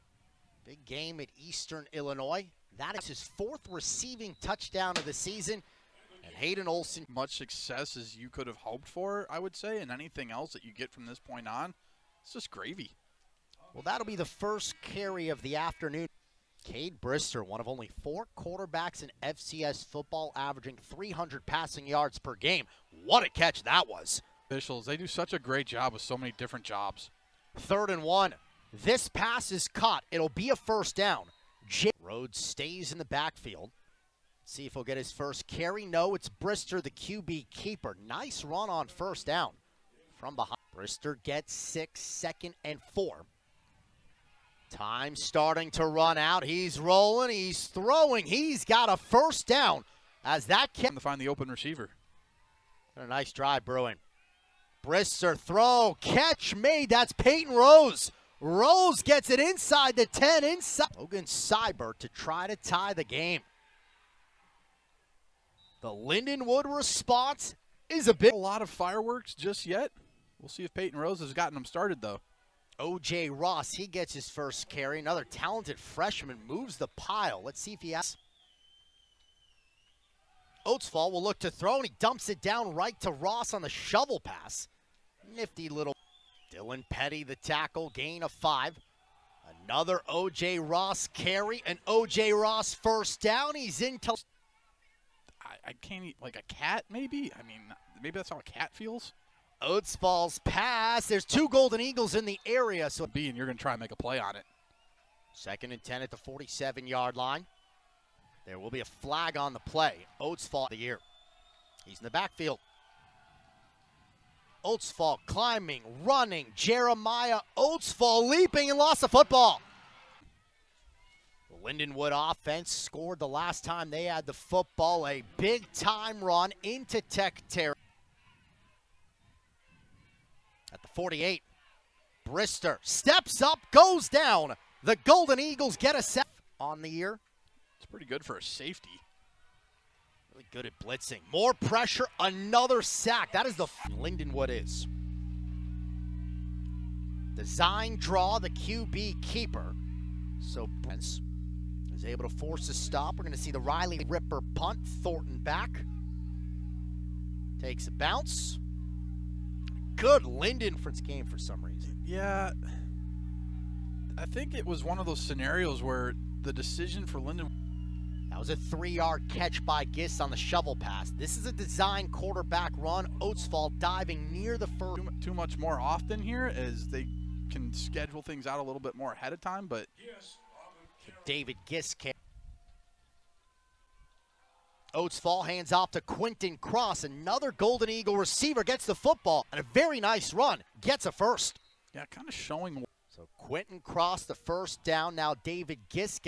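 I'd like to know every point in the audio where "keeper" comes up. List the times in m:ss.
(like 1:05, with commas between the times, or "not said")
0:37, 2:29.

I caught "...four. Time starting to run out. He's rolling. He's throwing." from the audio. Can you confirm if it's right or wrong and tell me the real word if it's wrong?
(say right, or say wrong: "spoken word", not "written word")
right.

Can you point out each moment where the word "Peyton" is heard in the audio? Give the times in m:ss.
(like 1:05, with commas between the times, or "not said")
0:57, 1:10.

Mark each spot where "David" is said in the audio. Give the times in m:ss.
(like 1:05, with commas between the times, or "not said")
3:01, 3:15.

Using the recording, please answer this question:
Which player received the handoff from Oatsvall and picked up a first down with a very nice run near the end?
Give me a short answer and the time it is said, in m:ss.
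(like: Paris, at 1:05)
Quinton Cross, at 3:06.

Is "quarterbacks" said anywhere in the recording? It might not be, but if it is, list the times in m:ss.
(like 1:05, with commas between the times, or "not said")
0:18, 2:52.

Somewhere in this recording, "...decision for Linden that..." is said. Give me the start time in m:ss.
2:46.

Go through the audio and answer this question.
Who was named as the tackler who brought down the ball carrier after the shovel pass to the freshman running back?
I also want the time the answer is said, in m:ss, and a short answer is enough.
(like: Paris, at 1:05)
Dylan Petty, at 1:26.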